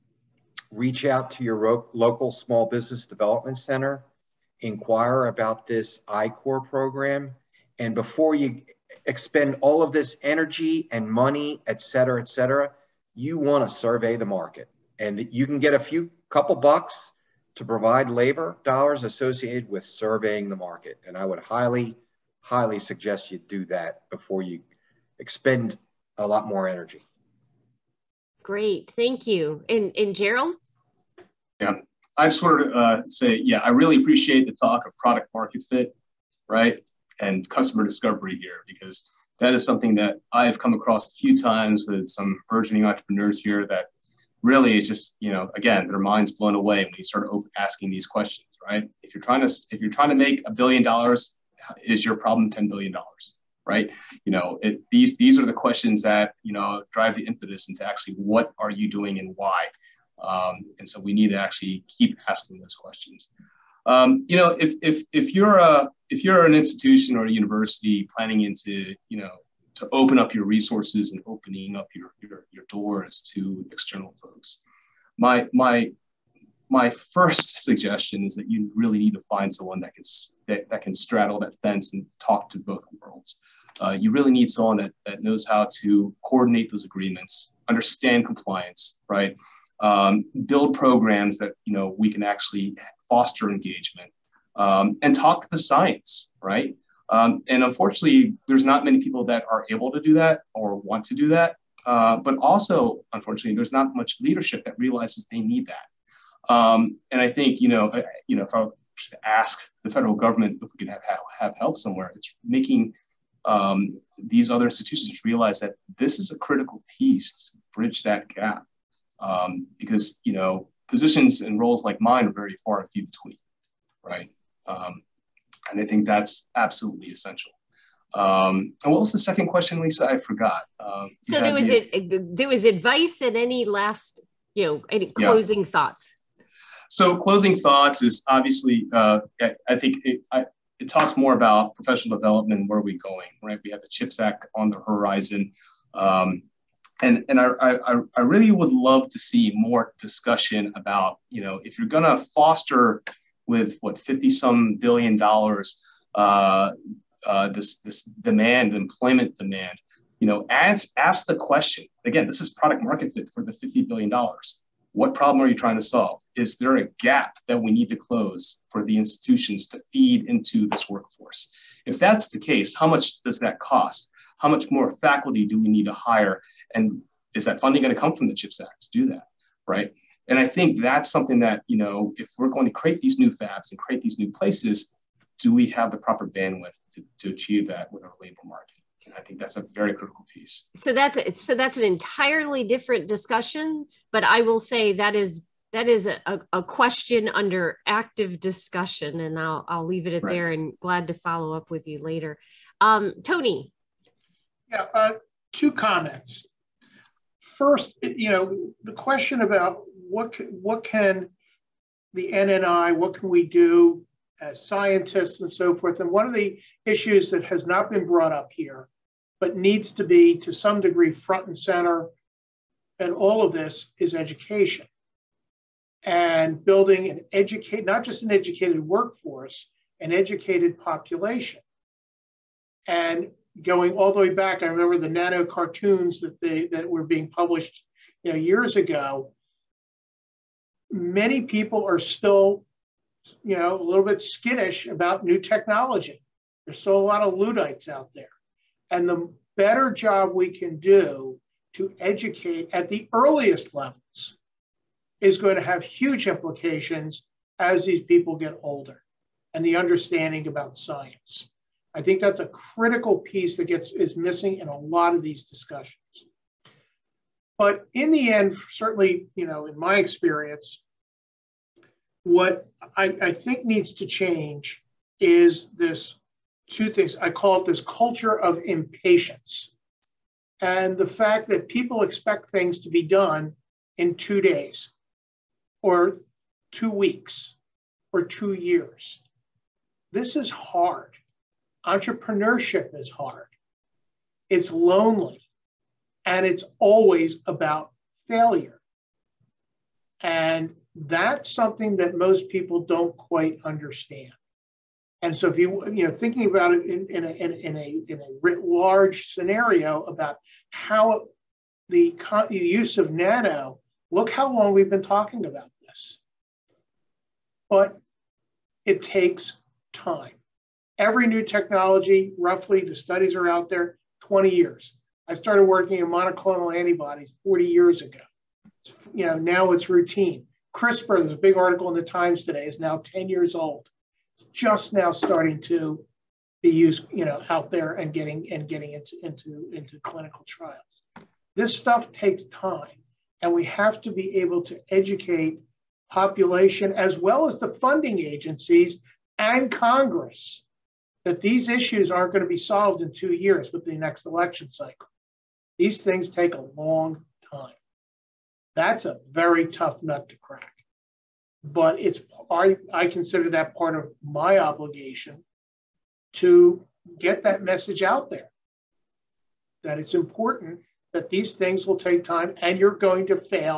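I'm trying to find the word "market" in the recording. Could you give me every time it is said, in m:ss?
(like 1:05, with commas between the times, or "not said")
0:14, 0:20, 0:35, 2:42, 3:08.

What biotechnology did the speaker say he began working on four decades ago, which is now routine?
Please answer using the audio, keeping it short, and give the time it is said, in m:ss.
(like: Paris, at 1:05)
monoclonal antibodies, at 5:26.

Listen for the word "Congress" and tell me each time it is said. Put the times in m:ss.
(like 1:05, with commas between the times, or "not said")
5:49.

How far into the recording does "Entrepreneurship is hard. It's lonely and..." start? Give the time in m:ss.
4:51.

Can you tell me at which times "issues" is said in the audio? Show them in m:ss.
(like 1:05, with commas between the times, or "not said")
3:36, 5:51.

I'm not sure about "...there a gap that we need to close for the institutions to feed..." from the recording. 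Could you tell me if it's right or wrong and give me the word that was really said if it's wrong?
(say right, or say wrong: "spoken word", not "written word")
right.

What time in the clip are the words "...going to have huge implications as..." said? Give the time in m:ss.
4:15.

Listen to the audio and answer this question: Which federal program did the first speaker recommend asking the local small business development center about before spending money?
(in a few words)
I-Corps.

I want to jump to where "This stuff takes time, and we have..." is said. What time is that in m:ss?
5:41.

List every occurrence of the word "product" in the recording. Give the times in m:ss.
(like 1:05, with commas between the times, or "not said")
0:34, 2:42.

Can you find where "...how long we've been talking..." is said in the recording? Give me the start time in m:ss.
5:14.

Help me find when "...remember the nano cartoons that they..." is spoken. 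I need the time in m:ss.
3:54.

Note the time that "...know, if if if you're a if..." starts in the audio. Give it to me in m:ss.
1:04.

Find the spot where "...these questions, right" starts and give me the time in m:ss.
0:47.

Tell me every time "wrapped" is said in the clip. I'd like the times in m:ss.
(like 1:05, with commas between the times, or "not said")
not said.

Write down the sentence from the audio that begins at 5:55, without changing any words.
These things take a long time.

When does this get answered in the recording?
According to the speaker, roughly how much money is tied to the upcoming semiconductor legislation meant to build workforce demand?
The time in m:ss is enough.
2:33.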